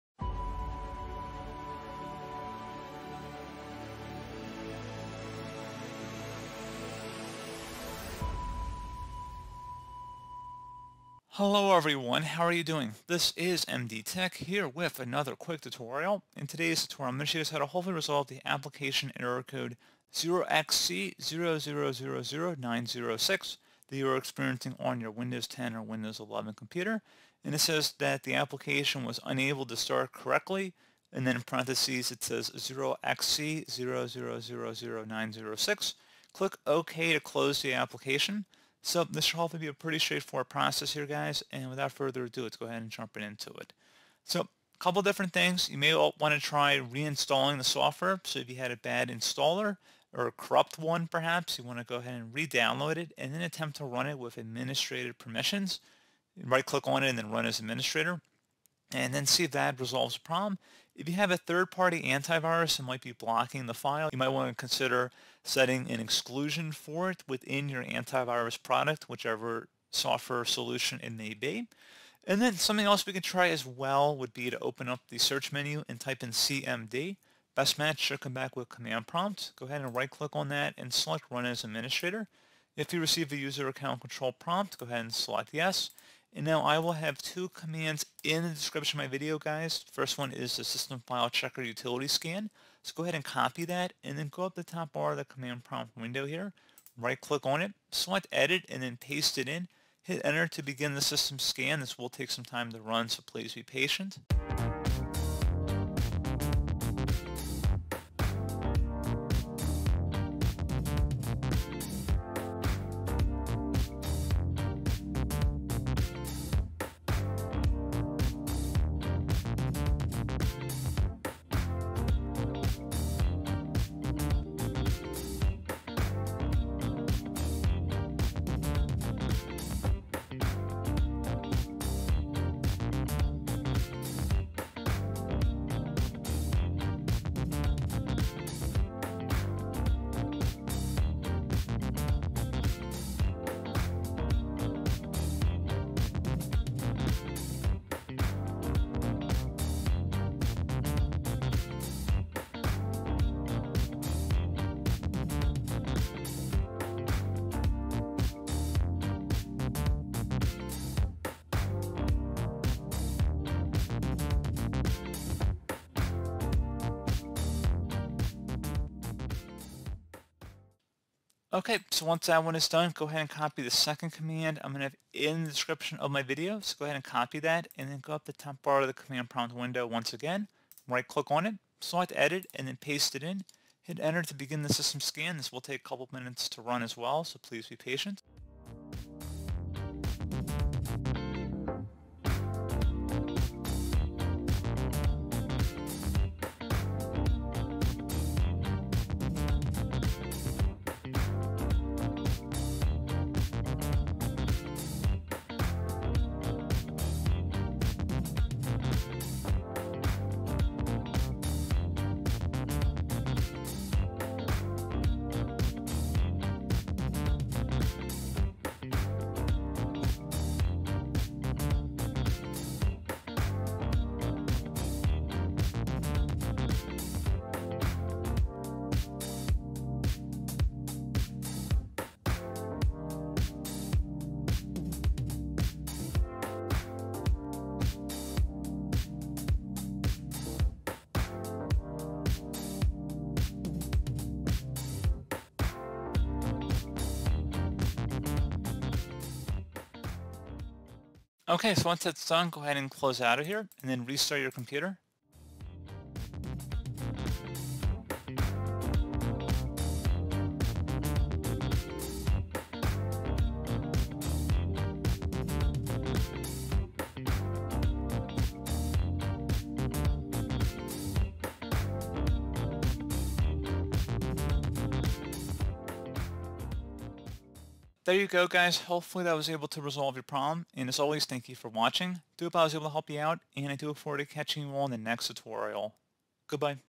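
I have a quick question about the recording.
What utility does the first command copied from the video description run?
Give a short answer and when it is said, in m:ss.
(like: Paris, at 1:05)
system file checker, at 1:30.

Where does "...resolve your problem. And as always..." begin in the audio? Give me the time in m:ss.
4:39.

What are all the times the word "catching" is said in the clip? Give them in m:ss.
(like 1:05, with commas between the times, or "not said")
4:44.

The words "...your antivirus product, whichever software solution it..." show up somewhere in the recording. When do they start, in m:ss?
1:07.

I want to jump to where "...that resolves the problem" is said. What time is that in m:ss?
0:59.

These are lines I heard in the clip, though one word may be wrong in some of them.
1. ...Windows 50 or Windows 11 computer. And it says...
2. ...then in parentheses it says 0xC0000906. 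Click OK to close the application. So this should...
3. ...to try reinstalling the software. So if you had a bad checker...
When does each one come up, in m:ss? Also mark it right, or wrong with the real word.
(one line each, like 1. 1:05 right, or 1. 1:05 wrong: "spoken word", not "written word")
1. 0:25 wrong: "10", not "50"
2. 0:31 right
3. 0:46 wrong: "installer", not "checker".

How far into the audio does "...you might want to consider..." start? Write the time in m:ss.
1:04.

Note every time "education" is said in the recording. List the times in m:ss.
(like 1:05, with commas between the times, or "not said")
not said.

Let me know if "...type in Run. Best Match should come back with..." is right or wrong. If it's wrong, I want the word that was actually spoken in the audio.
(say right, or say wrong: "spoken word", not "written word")
wrong: "CMD", not "Run".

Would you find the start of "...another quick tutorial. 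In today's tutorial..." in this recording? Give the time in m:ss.
0:14.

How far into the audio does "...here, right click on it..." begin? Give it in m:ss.
1:36.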